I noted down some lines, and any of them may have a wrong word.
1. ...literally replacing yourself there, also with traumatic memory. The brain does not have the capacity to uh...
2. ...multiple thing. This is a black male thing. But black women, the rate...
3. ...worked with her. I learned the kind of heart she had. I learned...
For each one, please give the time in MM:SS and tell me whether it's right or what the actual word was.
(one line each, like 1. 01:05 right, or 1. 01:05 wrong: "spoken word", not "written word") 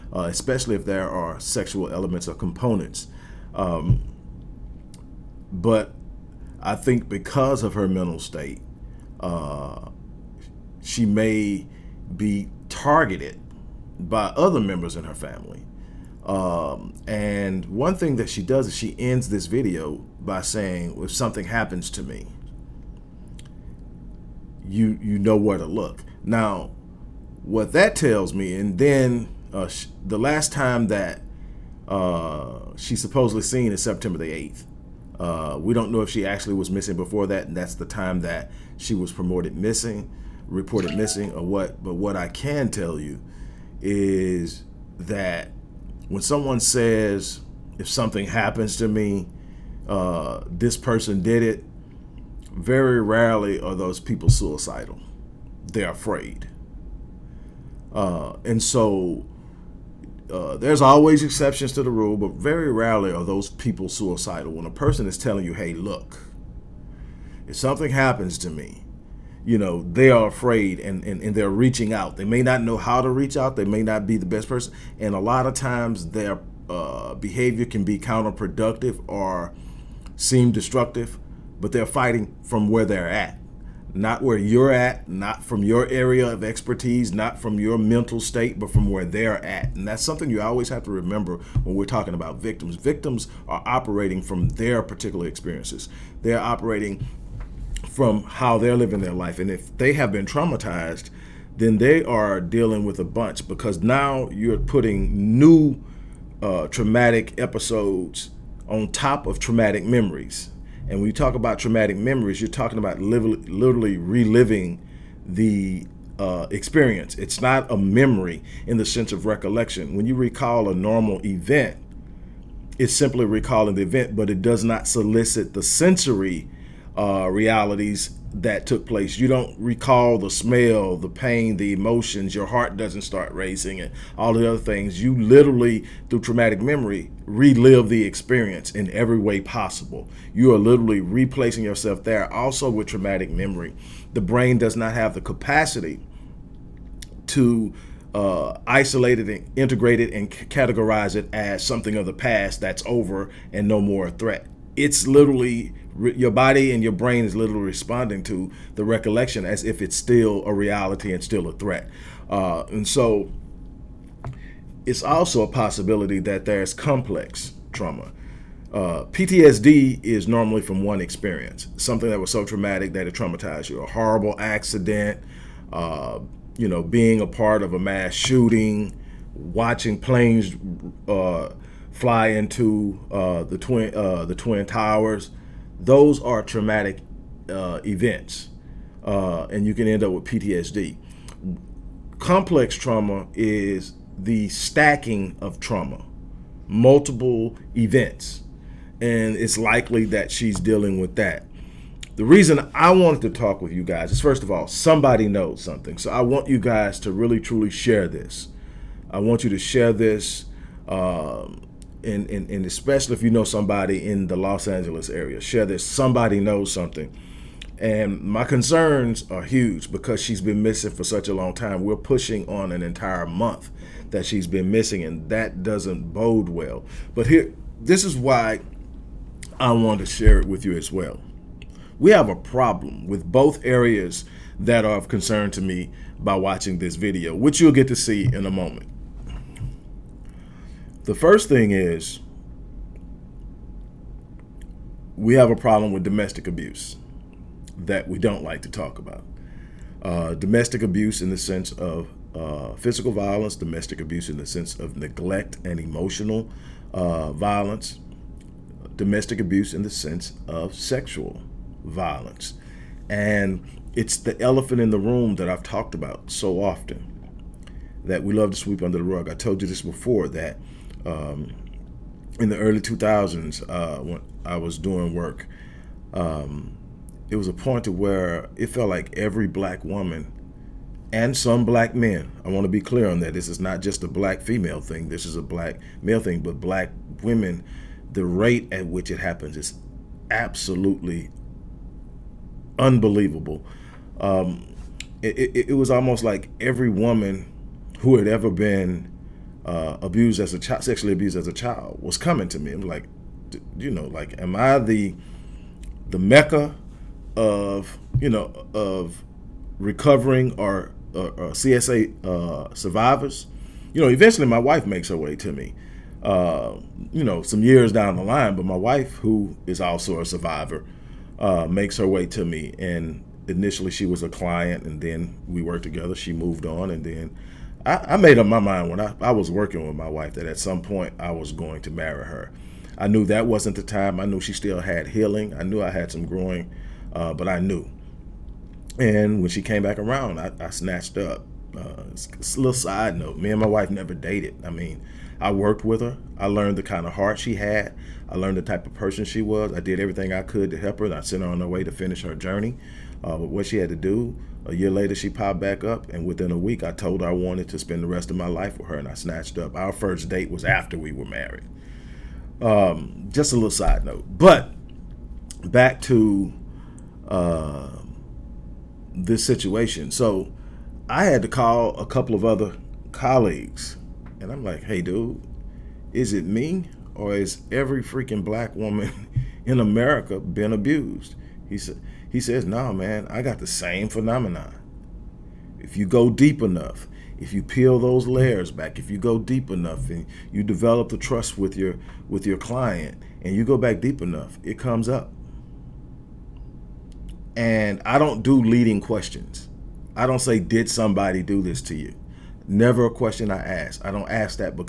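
1. 02:20 right
2. 04:44 wrong: "female", not "multiple"
3. 05:45 right.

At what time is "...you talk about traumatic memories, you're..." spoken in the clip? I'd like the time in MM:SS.
01:51.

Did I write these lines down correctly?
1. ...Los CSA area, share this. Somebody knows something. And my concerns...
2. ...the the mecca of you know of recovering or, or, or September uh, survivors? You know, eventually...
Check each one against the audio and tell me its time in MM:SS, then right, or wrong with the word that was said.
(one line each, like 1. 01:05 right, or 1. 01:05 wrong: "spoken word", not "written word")
1. 03:34 wrong: "Angeles", not "CSA"
2. 05:04 wrong: "CSA", not "September".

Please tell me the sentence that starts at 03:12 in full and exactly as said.
Complex trauma is the stacking of trauma, multiple events, and it's likely that she's dealing with that.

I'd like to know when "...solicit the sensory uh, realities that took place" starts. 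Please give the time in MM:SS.
02:04.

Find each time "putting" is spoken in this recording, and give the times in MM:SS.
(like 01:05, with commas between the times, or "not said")
01:44.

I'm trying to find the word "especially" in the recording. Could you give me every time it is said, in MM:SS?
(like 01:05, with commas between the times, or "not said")
00:00, 03:32.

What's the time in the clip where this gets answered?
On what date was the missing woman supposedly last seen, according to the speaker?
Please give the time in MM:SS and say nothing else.
00:33.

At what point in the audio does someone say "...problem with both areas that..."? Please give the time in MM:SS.
03:52.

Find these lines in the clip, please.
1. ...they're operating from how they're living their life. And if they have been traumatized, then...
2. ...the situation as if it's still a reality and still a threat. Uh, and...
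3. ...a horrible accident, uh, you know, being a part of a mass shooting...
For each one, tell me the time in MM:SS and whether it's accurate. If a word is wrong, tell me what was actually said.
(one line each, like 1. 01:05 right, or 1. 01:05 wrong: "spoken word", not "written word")
1. 01:36 right
2. 02:38 wrong: "recollection", not "situation"
3. 02:53 right.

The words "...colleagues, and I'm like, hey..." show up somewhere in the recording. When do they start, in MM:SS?
06:13.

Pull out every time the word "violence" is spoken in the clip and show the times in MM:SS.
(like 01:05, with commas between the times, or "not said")
04:13, 04:17, 04:21.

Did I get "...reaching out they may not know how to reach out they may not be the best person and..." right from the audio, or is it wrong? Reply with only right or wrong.
right.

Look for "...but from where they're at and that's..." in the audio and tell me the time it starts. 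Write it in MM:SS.
01:28.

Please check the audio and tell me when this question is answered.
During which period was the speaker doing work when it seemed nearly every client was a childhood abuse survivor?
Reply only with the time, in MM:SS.
04:32.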